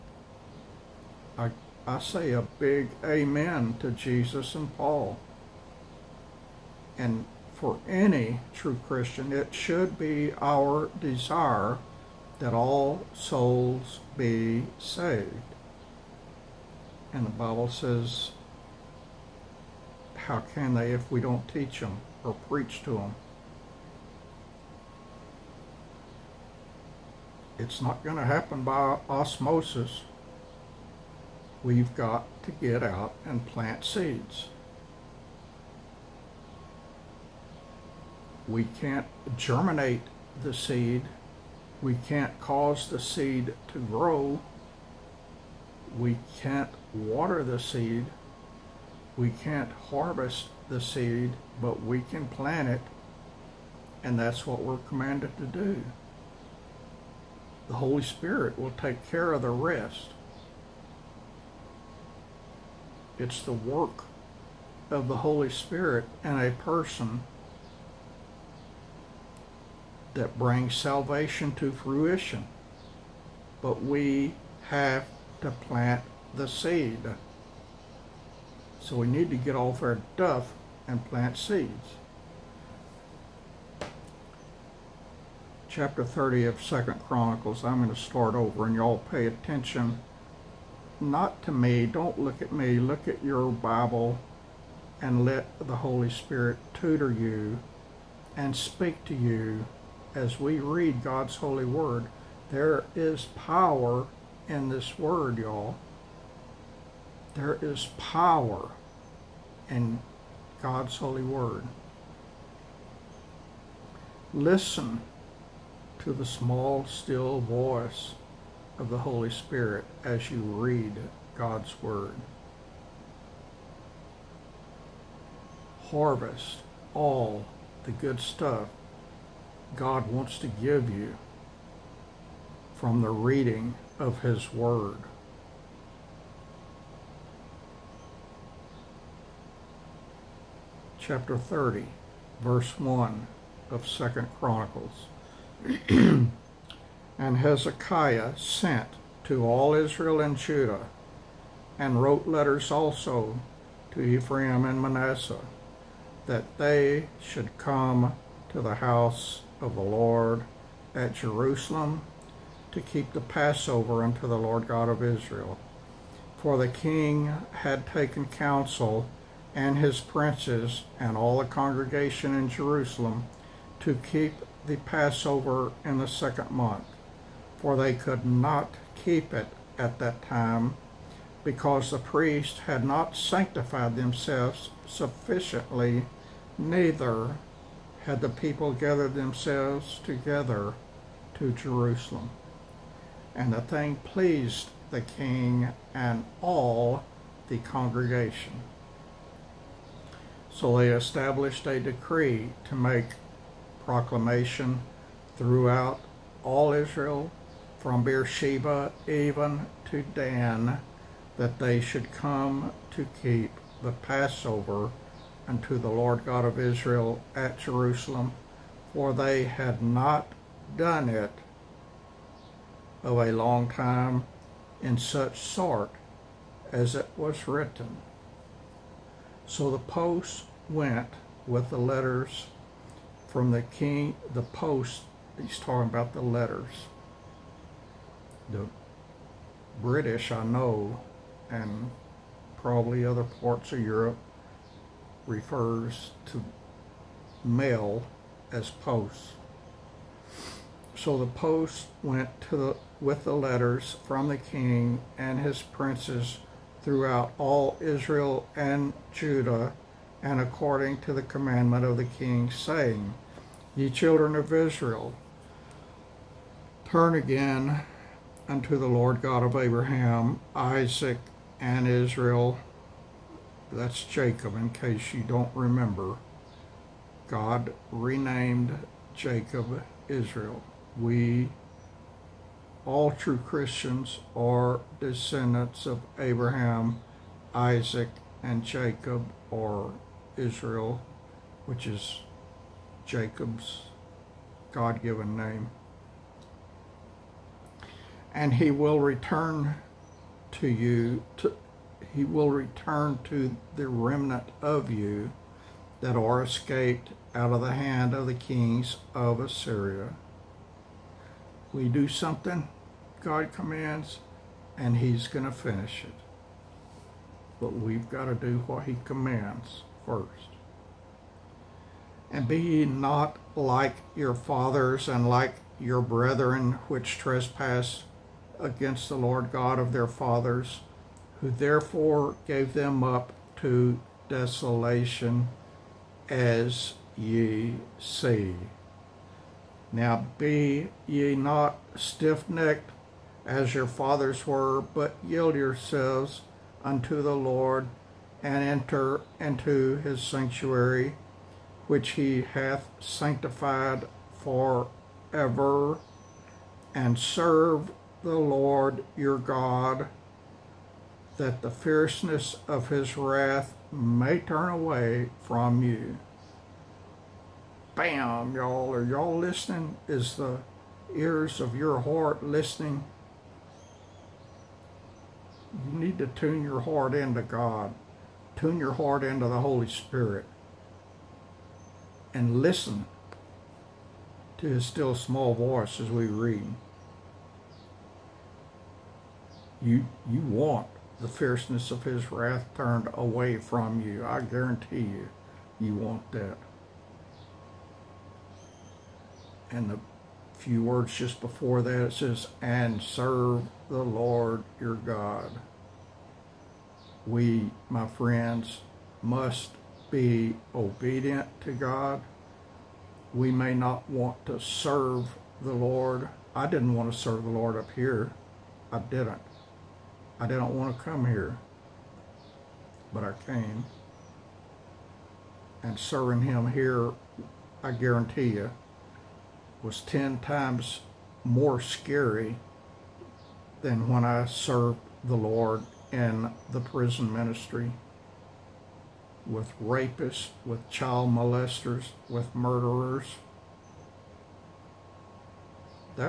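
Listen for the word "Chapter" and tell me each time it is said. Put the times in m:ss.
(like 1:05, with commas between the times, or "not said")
1:25, 2:20.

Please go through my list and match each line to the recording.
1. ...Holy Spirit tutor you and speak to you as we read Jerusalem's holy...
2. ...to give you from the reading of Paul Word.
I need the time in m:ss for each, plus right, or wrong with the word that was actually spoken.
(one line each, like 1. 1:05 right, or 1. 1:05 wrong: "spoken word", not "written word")
1. 1:35 wrong: "God", not "Jerusalem"
2. 2:10 wrong: "His", not "Paul".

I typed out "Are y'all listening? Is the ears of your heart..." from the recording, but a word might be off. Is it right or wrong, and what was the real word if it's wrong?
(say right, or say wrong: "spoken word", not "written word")
right.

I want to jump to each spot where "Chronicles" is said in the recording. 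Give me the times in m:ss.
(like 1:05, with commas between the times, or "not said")
1:27, 2:24.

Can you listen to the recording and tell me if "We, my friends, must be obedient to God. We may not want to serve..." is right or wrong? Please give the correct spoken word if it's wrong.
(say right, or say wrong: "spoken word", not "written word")
right.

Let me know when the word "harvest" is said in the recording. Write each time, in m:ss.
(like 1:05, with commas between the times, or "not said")
0:49, 2:05.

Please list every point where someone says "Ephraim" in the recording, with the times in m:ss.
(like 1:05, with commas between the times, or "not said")
2:34.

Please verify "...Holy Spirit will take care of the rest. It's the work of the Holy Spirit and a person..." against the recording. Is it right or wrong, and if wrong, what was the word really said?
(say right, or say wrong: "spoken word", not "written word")
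right.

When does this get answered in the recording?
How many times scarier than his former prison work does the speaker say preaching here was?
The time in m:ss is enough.
7:10.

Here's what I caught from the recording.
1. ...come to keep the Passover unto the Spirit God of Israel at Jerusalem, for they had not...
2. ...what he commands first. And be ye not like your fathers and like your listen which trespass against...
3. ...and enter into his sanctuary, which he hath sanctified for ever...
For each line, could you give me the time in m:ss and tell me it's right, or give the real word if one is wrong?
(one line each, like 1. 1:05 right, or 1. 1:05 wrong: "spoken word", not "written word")
1. 3:32 wrong: "Lord", not "Spirit"
2. 5:18 wrong: "brethren", not "listen"
3. 5:48 right.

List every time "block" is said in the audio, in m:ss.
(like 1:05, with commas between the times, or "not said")
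not said.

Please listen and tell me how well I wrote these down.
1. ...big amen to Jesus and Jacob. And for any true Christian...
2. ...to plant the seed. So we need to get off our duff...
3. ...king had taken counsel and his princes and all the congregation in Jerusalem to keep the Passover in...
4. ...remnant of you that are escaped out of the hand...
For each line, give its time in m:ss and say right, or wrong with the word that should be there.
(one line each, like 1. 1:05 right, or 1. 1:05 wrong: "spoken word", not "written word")
1. 0:02 wrong: "Paul", not "Jacob"
2. 1:15 right
3. 2:46 right
4. 5:03 right.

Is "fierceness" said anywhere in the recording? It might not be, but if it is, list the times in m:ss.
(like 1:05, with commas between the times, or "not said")
6:01, 6:31.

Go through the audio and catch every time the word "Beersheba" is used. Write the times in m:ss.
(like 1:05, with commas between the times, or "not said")
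3:28.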